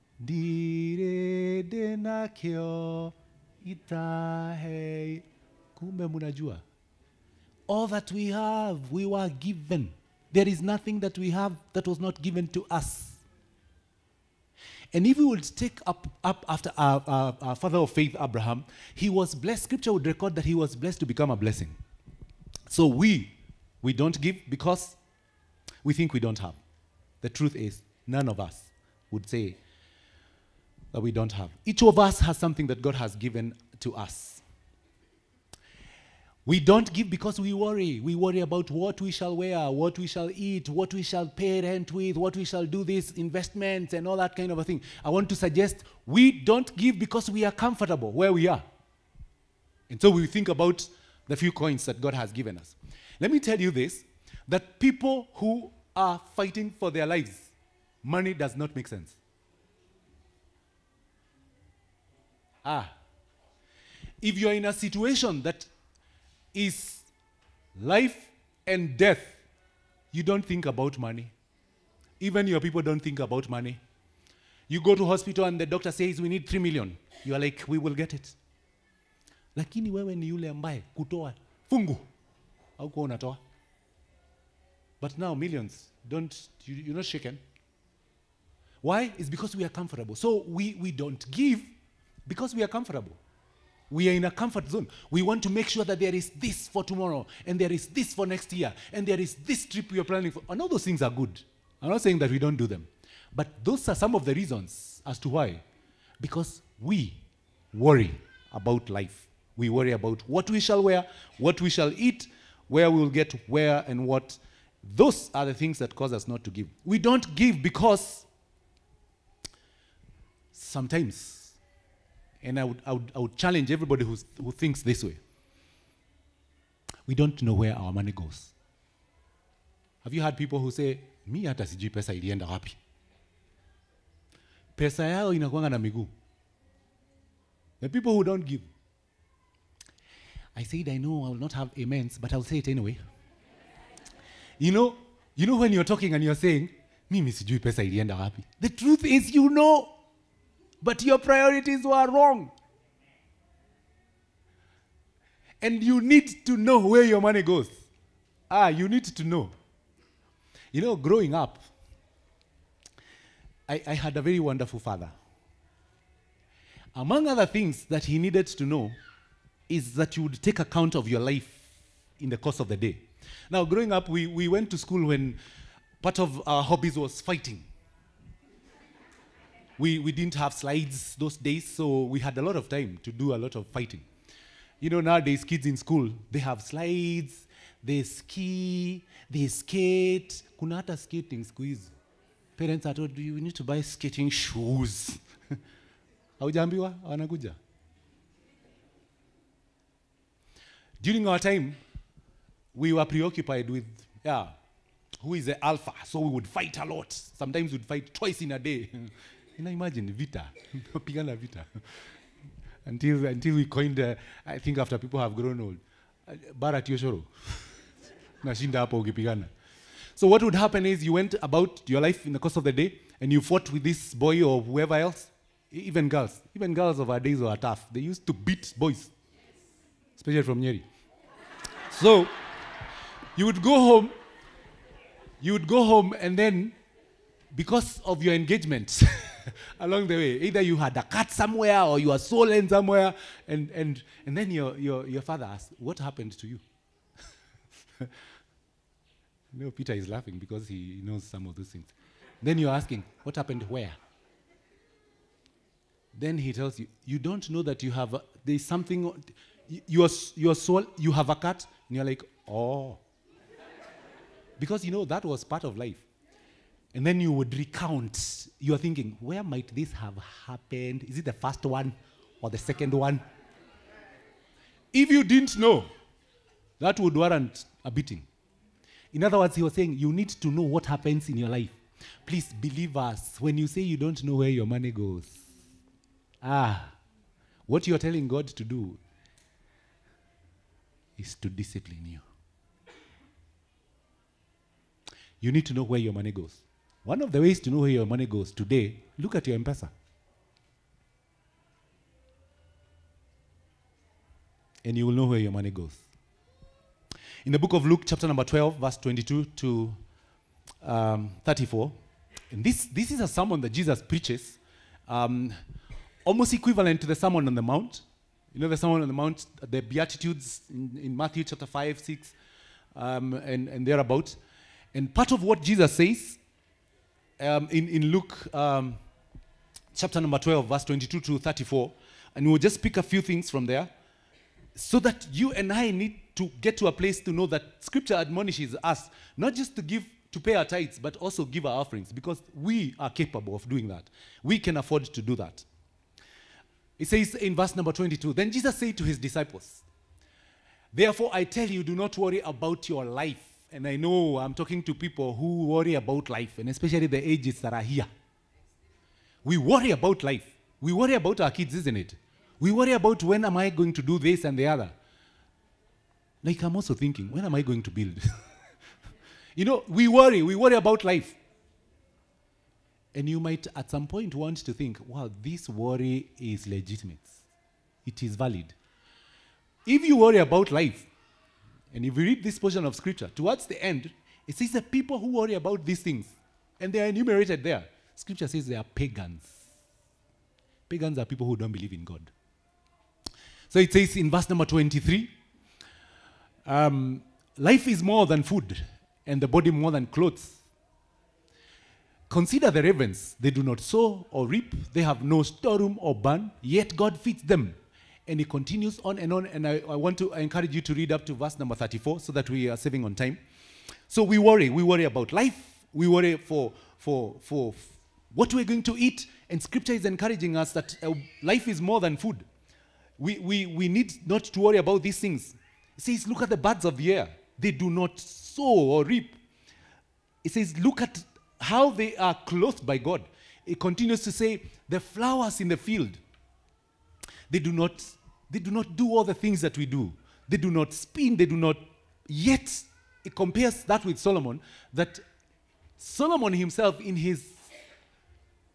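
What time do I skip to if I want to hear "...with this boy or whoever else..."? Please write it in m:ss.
3:43.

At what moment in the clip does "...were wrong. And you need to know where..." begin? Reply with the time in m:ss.
2:31.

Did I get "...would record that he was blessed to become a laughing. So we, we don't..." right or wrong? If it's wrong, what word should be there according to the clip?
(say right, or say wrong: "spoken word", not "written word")
wrong: "blessing", not "laughing".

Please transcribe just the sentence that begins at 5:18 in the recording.
You know the Sermon on the Mount, the Beatitudes in, in Matthew chapter 5, 6, um, and, and thereabout.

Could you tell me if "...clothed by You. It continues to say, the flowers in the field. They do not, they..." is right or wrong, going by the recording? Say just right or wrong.
wrong.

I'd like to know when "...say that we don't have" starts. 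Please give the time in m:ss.
0:29.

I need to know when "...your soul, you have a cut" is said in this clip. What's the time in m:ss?
4:20.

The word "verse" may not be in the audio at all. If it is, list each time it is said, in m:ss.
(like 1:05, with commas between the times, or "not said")
5:08, 5:30, 5:47, 6:34, 6:51.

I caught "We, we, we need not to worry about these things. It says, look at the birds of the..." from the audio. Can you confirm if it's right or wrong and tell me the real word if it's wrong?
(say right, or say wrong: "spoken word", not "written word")
right.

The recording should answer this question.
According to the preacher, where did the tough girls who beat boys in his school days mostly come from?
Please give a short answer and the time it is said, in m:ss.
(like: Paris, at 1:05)
Nyeri, at 3:50.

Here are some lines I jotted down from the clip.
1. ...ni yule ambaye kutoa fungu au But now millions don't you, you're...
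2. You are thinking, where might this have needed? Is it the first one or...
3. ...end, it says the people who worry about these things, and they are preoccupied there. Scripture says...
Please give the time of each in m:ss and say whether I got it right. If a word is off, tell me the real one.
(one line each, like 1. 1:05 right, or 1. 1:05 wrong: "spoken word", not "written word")
1. 1:20 right
2. 4:28 wrong: "happened", not "needed"
3. 6:23 wrong: "enumerated", not "preoccupied".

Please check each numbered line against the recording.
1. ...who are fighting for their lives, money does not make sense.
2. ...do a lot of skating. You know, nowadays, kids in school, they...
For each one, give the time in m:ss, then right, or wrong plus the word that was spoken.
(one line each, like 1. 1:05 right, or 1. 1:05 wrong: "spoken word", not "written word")
1. 0:55 right
2. 3:03 wrong: "fighting", not "skating".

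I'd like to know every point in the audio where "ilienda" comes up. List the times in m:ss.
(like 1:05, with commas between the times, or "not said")
2:12, 2:27.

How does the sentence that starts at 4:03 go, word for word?
And, and, and then your, your, your father asked, What happened to you?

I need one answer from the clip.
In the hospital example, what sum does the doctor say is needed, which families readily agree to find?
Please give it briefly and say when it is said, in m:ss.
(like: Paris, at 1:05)
3 million, at 1:16.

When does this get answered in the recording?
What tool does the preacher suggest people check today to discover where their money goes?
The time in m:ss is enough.
4:59.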